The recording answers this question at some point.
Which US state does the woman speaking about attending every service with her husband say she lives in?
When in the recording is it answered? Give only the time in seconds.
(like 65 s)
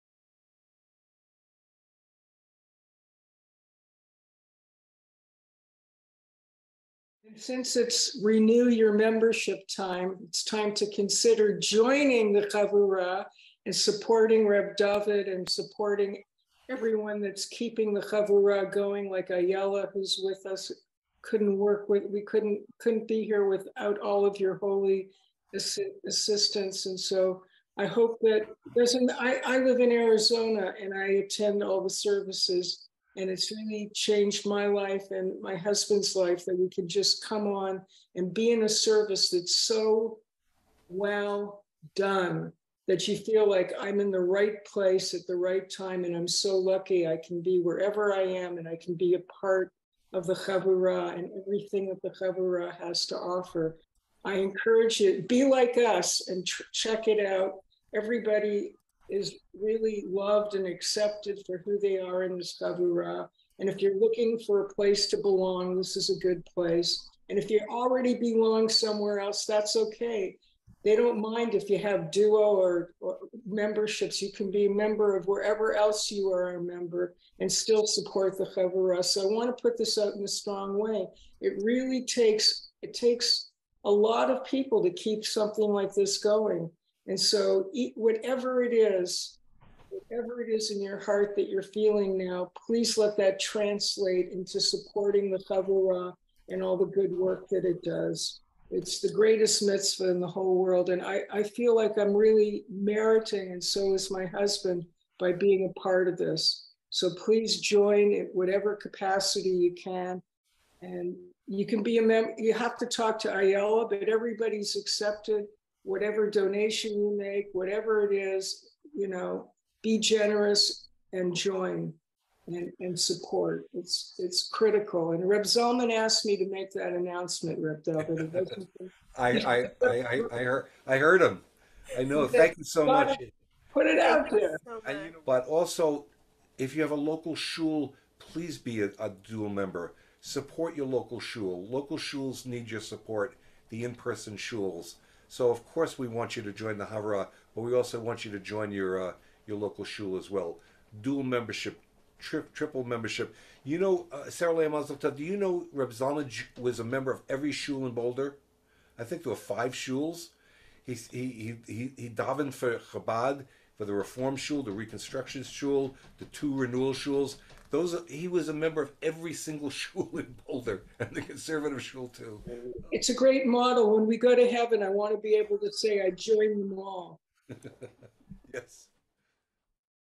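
29 s.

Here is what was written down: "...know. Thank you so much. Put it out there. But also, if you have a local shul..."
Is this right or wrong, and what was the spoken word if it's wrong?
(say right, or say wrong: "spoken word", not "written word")
right.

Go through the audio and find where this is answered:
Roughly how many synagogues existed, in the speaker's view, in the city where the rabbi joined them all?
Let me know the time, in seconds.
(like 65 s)
159 s.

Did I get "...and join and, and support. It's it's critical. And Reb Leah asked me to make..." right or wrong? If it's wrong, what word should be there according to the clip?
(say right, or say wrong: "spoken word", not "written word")
wrong: "Zalman", not "Leah".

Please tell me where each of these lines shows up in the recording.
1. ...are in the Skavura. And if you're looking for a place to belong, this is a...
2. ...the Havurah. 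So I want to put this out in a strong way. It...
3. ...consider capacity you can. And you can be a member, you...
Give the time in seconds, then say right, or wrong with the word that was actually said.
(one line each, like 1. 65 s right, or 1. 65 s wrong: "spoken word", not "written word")
1. 61 s right
2. 78 s right
3. 108 s wrong: "whatever", not "consider".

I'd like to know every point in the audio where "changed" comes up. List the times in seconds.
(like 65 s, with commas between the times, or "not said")
33 s.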